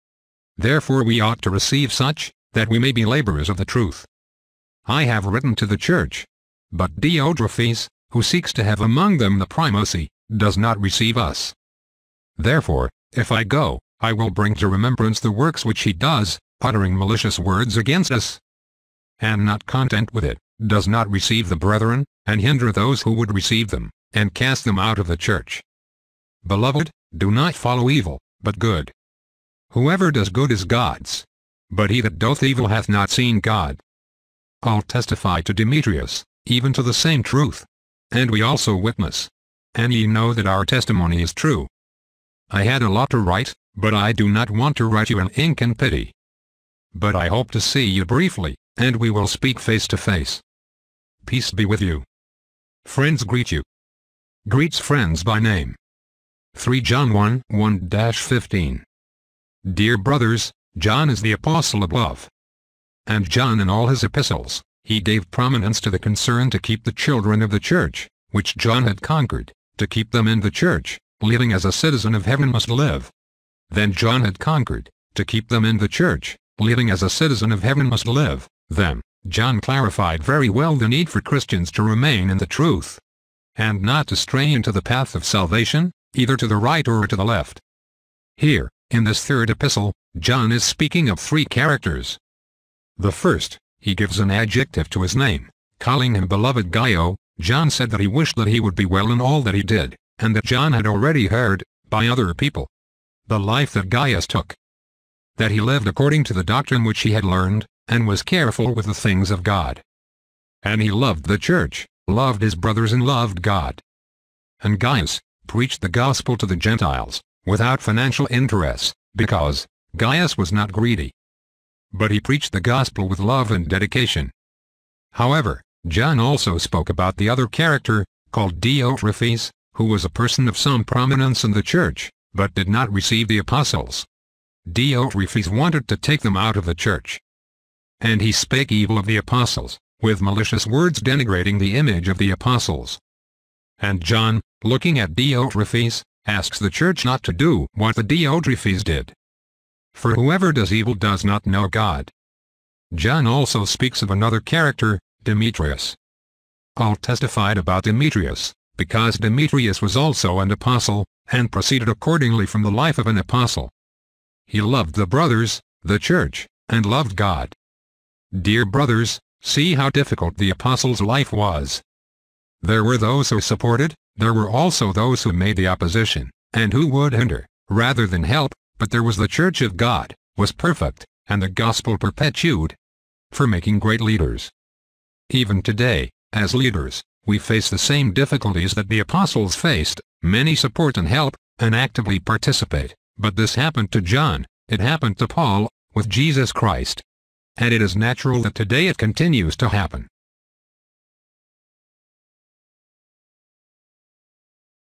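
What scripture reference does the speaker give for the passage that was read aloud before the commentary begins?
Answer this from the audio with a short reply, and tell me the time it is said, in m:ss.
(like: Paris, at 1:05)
3 John 1:1-15, at 0:56.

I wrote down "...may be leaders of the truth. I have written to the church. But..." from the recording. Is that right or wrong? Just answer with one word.
wrong.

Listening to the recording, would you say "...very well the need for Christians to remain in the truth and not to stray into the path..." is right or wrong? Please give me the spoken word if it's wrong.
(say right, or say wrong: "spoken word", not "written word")
right.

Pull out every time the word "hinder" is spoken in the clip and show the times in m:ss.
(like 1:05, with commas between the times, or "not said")
0:22, 2:57.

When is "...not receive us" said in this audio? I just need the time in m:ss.
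0:10.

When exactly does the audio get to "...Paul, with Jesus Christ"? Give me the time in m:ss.
3:15.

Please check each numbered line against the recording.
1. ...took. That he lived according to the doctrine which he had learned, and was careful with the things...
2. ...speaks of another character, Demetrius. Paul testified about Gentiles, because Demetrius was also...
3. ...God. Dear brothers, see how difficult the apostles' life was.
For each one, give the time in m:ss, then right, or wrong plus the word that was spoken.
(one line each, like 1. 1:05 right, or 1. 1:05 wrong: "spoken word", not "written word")
1. 1:44 right
2. 2:33 wrong: "Demetrius", not "Gentiles"
3. 2:47 right.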